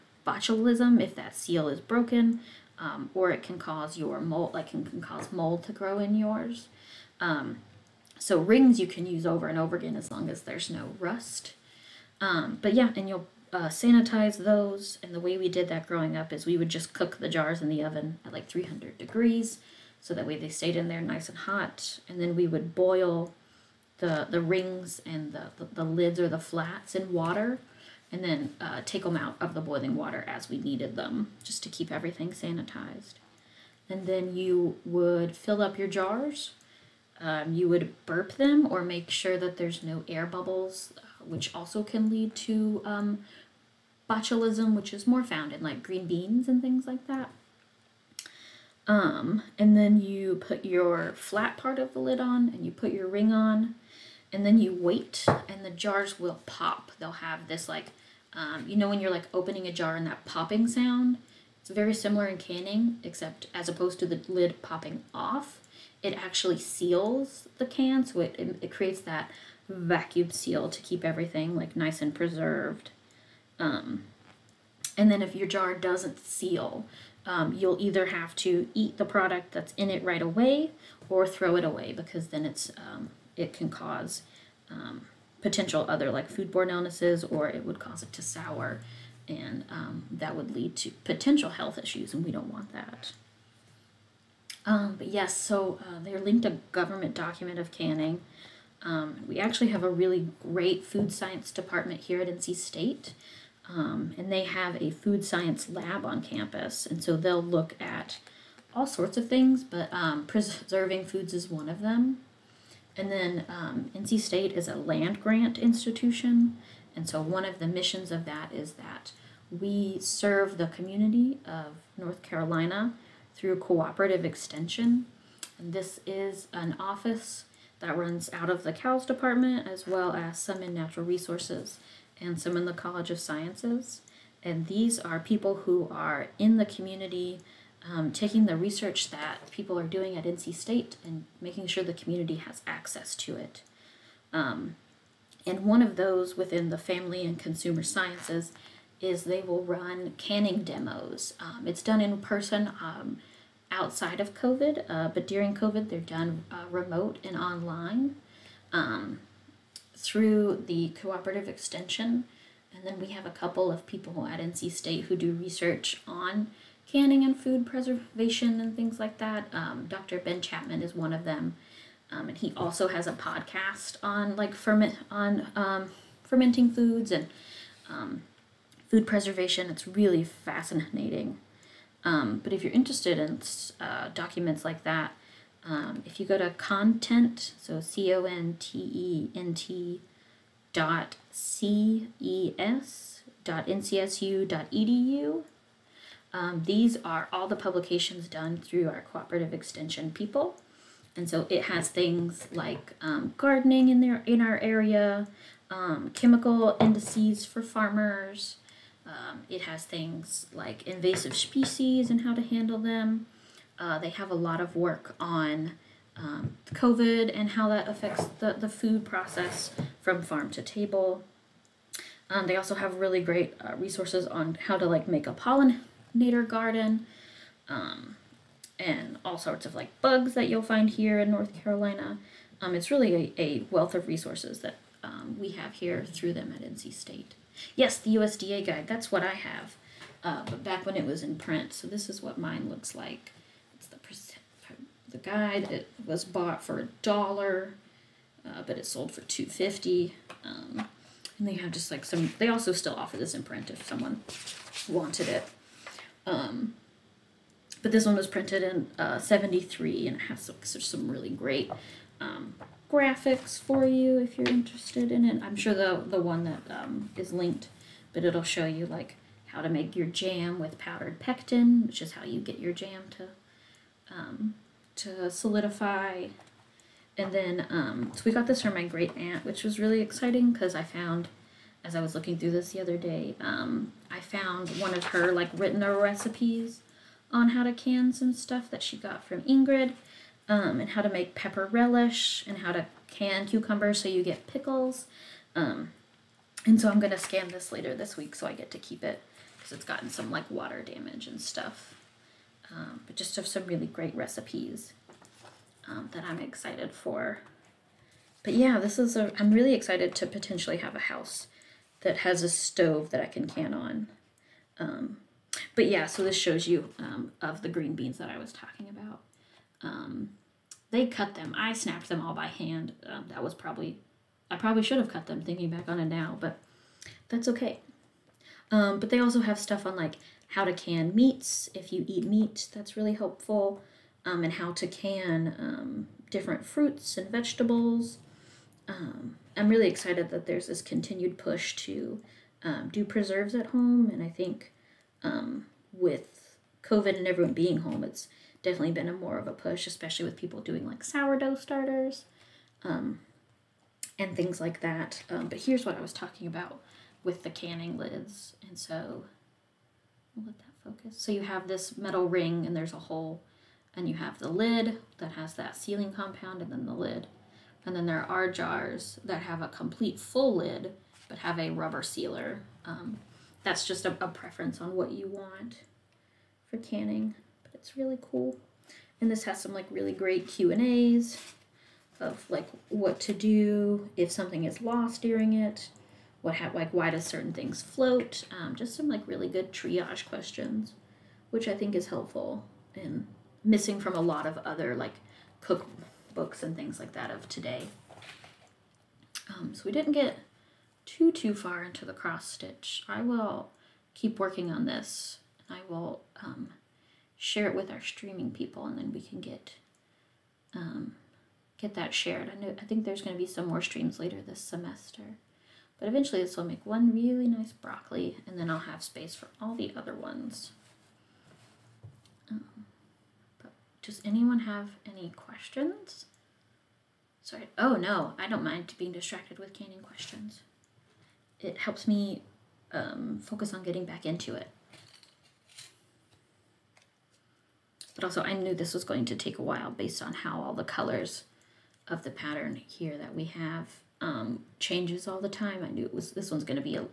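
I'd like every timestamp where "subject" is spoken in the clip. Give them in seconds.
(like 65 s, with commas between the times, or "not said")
not said.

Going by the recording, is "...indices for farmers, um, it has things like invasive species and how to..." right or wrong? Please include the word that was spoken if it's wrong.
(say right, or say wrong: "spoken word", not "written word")
right.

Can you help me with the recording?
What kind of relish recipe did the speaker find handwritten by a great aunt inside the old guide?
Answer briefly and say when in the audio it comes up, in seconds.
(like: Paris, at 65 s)
Pepper relish, at 291 s.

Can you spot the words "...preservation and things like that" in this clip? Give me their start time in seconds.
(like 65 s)
167 s.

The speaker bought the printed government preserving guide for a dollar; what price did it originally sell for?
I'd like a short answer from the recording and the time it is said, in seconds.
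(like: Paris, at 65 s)
2.50, at 249 s.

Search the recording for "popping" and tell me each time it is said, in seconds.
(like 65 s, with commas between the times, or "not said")
60 s, 64 s.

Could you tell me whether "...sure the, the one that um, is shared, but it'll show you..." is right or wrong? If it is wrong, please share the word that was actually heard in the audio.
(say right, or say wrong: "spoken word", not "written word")
wrong: "linked", not "shared".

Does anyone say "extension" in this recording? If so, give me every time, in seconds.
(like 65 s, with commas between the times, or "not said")
124 s, 161 s, 199 s.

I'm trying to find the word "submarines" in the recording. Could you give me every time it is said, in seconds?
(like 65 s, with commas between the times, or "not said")
not said.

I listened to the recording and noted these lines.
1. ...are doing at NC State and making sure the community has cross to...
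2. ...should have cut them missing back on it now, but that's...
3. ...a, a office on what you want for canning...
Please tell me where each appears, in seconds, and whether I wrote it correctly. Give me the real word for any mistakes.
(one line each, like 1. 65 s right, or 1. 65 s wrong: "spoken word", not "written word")
1. 139 s wrong: "access", not "cross"
2. 324 s wrong: "thinking", not "missing"
3. 374 s wrong: "preference", not "office".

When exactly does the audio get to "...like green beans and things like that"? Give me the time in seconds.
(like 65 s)
45 s.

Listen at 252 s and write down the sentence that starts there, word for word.
They also still offer this in print if someone wanted it.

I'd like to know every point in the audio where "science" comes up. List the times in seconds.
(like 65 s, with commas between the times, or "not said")
101 s, 105 s, 133 s, 147 s.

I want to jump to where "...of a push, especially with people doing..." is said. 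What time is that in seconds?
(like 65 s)
349 s.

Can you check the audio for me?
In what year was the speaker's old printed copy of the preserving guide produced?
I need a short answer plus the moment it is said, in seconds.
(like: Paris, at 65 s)
1973, at 259 s.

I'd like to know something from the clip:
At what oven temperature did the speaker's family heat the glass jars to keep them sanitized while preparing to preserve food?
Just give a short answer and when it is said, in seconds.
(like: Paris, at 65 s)
300 degrees, at 18 s.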